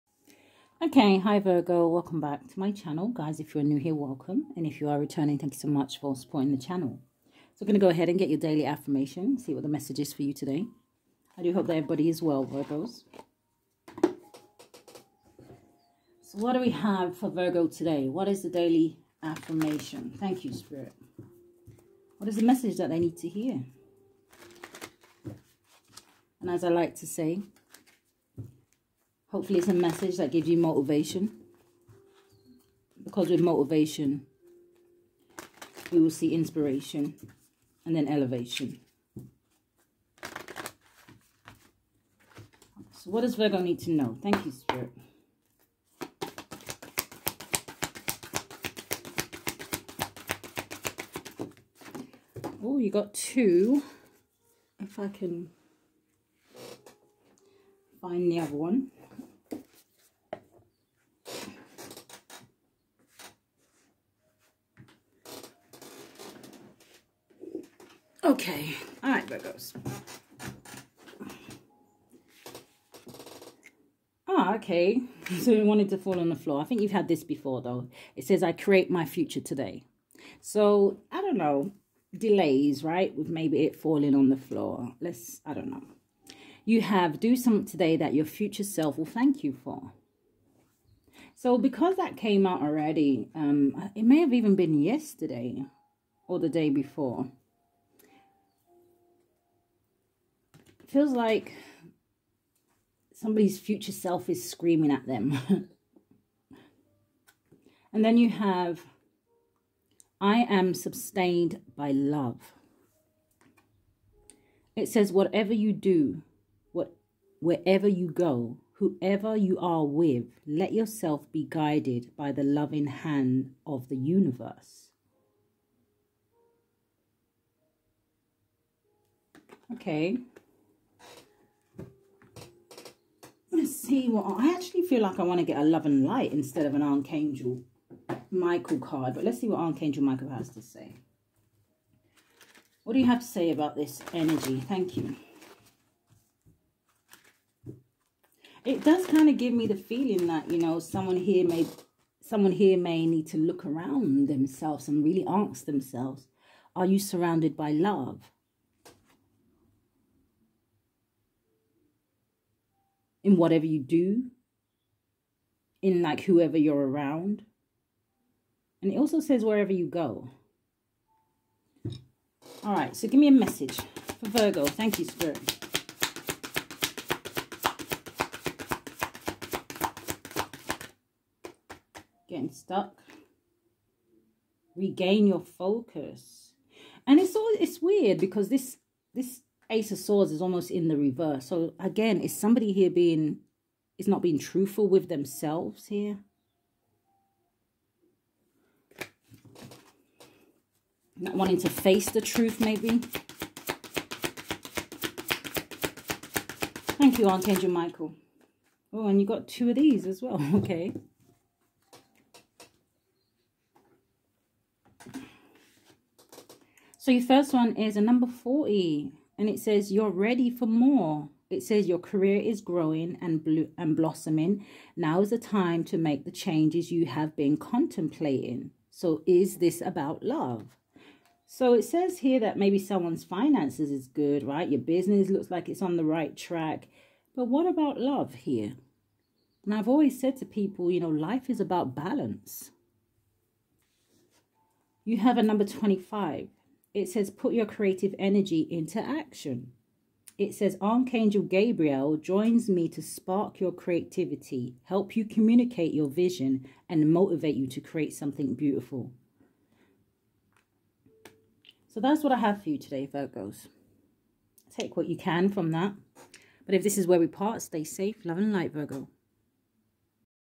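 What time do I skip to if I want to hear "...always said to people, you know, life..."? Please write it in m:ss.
3:59.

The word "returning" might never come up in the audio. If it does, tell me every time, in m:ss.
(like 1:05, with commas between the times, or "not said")
0:04.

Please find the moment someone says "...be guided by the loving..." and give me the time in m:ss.
2:01.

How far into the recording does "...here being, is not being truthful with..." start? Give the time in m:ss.
3:12.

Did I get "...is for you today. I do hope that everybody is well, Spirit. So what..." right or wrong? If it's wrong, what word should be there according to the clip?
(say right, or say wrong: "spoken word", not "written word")
wrong: "Virgos", not "Spirit".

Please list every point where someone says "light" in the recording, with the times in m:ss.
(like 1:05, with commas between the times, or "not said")
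2:16, 4:28.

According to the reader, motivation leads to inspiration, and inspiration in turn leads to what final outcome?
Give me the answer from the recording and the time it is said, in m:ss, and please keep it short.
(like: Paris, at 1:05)
elevation, at 0:38.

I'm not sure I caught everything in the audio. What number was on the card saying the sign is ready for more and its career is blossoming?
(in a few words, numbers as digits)
40.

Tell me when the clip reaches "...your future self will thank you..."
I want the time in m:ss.
1:28.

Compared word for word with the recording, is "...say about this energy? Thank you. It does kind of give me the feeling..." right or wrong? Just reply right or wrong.
right.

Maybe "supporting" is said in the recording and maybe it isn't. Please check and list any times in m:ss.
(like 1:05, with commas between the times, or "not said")
0:06.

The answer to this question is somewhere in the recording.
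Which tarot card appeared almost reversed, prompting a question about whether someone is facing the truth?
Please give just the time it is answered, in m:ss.
3:09.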